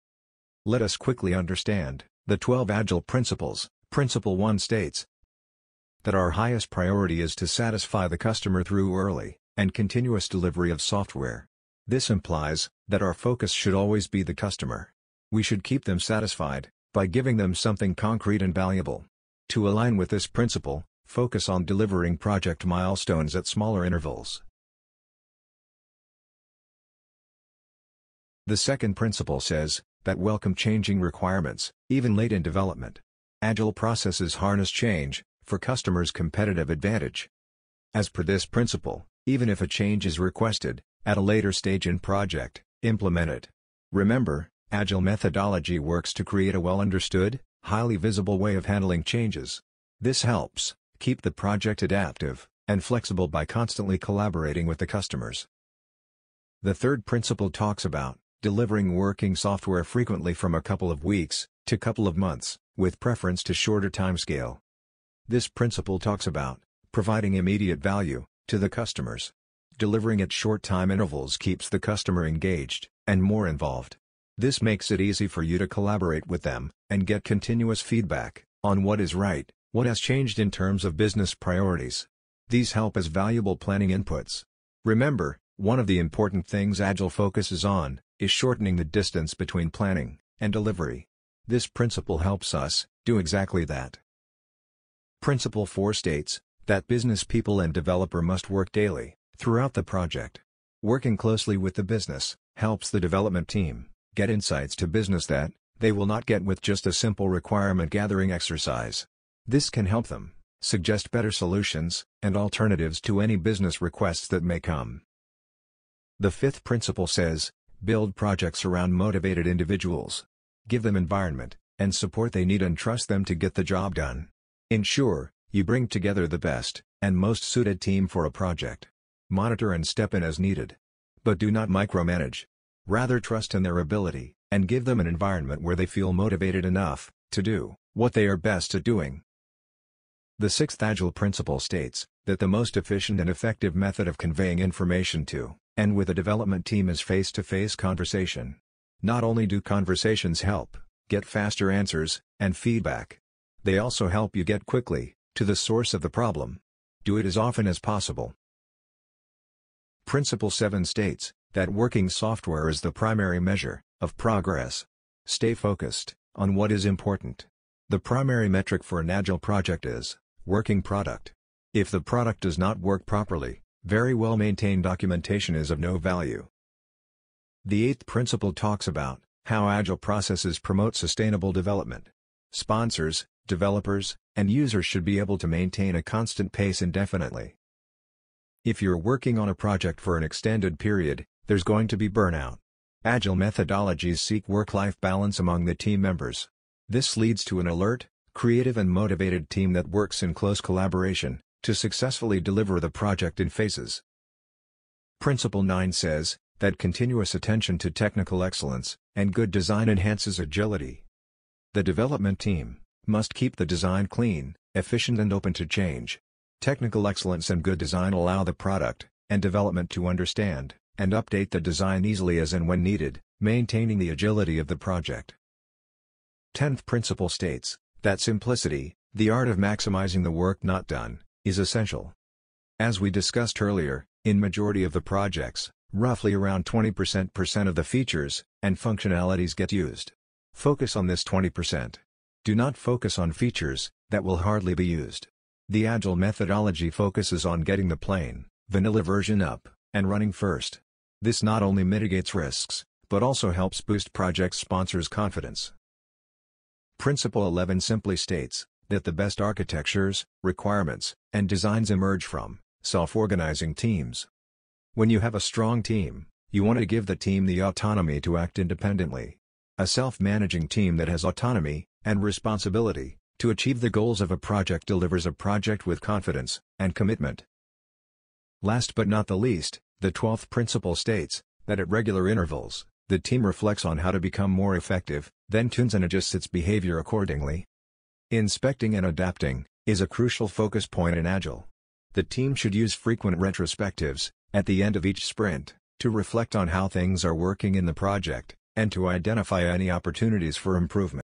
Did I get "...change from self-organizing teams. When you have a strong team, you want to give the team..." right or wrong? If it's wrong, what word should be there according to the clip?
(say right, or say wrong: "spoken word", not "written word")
wrong: "emerge", not "change".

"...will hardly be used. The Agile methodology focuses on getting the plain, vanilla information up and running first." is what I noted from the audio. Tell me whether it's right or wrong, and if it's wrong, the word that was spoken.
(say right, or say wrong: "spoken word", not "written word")
wrong: "version", not "information".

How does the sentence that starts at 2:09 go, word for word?
Monitor and step in as needed.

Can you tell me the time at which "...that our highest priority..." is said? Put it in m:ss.
0:06.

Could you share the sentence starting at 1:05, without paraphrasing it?
This principle talks about providing immediate value to the customers.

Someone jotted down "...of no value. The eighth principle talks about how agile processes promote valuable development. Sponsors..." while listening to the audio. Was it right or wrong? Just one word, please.
wrong.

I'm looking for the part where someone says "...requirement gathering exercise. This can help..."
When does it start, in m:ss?
1:47.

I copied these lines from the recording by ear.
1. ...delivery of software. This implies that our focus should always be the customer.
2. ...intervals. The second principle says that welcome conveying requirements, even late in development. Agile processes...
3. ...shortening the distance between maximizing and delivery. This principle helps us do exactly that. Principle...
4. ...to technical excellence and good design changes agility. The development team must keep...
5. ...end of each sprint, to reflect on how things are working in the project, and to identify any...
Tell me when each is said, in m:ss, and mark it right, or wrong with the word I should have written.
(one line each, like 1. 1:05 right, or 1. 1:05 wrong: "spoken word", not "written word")
1. 0:10 right
2. 0:23 wrong: "changing", not "conveying"
3. 1:28 wrong: "planning", not "maximizing"
4. 3:27 wrong: "enhances", not "changes"
5. 4:54 right.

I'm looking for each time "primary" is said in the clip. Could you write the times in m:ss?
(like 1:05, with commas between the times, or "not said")
2:42, 2:48.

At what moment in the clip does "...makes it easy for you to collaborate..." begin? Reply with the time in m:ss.
1:14.